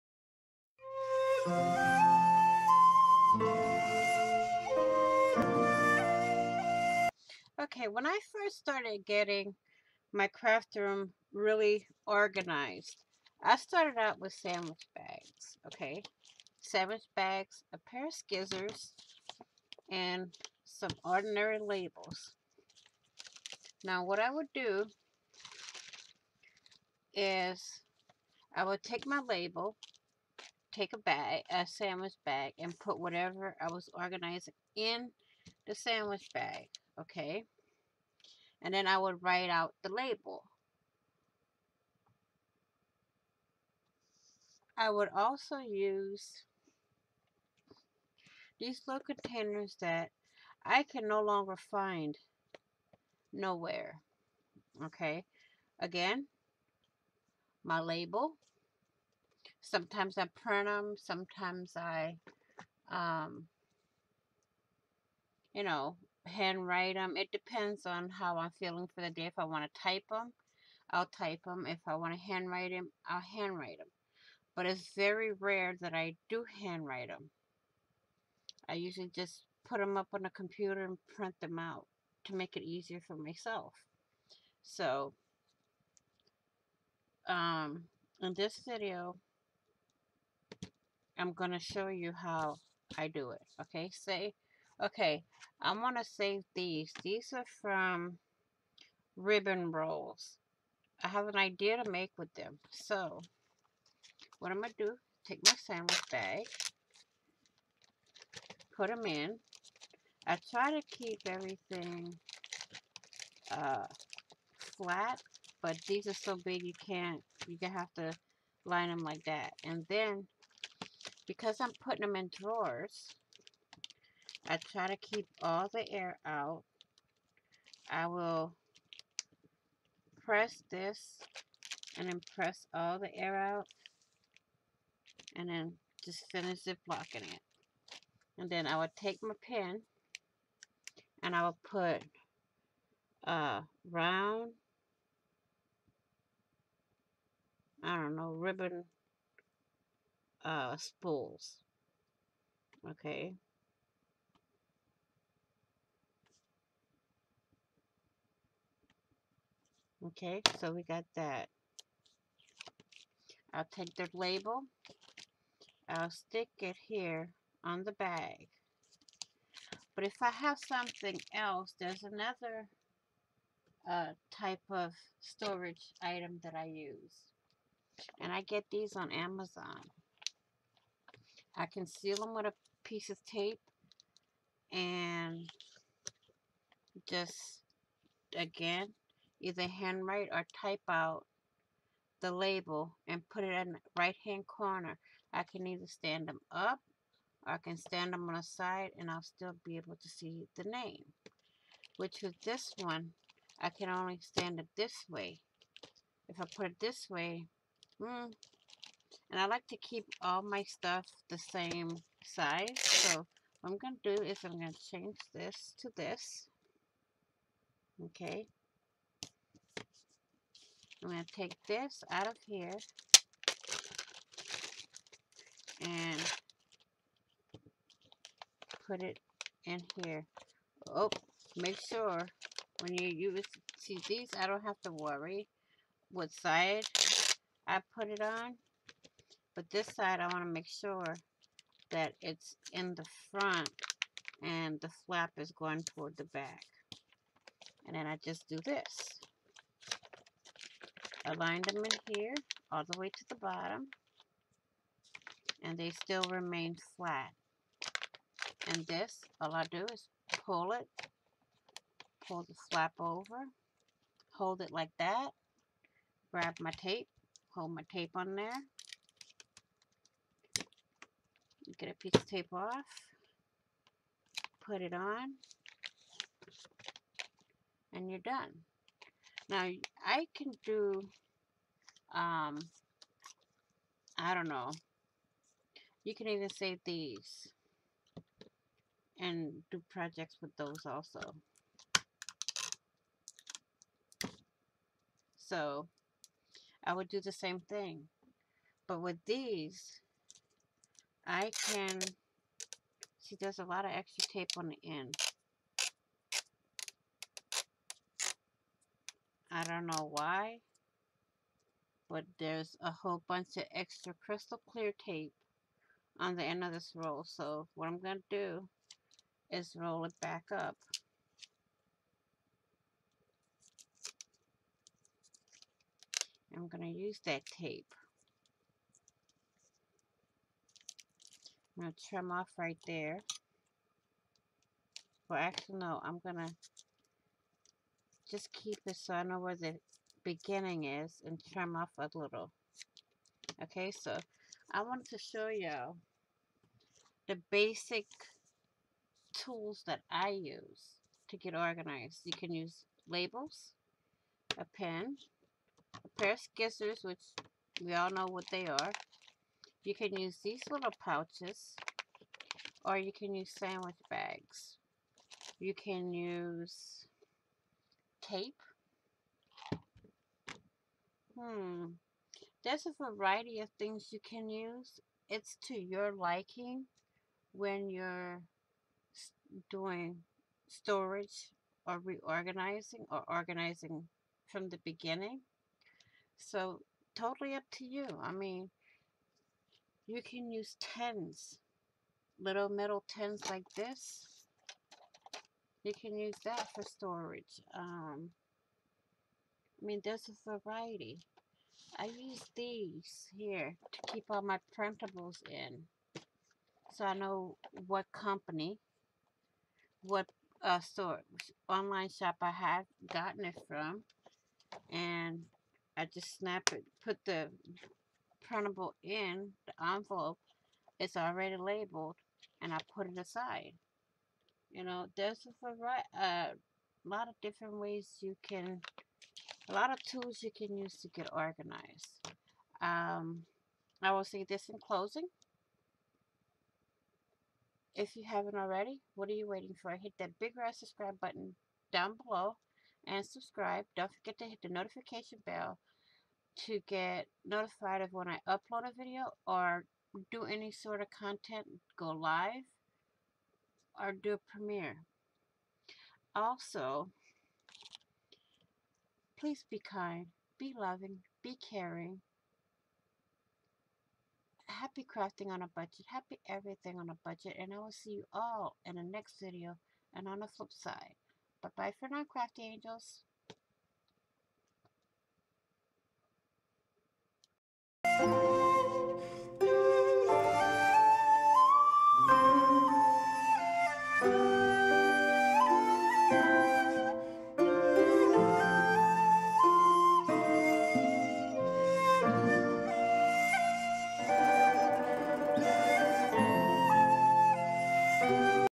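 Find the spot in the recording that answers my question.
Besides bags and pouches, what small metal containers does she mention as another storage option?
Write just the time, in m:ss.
6:32.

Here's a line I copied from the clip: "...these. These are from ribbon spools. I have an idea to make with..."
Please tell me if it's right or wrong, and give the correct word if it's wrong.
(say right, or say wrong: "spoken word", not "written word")
wrong: "rolls", not "spools".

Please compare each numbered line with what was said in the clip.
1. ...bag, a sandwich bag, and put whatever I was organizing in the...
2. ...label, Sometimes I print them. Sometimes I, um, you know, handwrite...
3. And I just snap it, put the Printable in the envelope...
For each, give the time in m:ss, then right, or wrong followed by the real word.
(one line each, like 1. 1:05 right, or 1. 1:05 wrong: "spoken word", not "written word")
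1. 0:30 right
2. 0:57 right
3. 6:54 right.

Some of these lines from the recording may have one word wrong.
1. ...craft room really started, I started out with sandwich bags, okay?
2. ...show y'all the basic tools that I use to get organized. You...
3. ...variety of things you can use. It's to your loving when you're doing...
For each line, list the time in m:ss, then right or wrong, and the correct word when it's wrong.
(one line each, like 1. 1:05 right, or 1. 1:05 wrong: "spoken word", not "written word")
1. 0:10 wrong: "organized", not "started"
2. 5:45 right
3. 6:13 wrong: "liking", not "loving".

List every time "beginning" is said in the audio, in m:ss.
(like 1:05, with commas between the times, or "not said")
5:40, 6:24.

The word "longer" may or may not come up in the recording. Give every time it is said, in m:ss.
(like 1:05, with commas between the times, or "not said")
0:51.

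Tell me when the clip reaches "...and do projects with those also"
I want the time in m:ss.
4:49.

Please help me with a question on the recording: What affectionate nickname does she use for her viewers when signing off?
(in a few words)
Crafty angels.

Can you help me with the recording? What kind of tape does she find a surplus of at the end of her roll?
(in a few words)
Crystal clear tape.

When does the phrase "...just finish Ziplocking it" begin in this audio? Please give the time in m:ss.
2:16.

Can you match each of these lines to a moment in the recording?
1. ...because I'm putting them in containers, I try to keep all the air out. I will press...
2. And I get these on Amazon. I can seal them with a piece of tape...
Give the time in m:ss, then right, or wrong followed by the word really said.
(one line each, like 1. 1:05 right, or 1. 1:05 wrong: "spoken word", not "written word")
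1. 2:01 wrong: "drawers", not "containers"
2. 2:58 right.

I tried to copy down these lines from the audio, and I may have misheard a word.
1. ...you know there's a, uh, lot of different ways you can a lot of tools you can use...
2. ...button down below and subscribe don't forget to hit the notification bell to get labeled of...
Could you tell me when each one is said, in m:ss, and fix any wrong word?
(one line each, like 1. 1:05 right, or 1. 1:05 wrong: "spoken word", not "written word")
1. 7:04 right
2. 7:21 wrong: "notified", not "labeled".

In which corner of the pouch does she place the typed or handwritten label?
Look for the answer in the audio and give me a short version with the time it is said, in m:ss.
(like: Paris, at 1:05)
Right hand corner, at 3:13.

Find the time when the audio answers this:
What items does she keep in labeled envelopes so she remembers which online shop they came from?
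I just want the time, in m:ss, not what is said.
6:44.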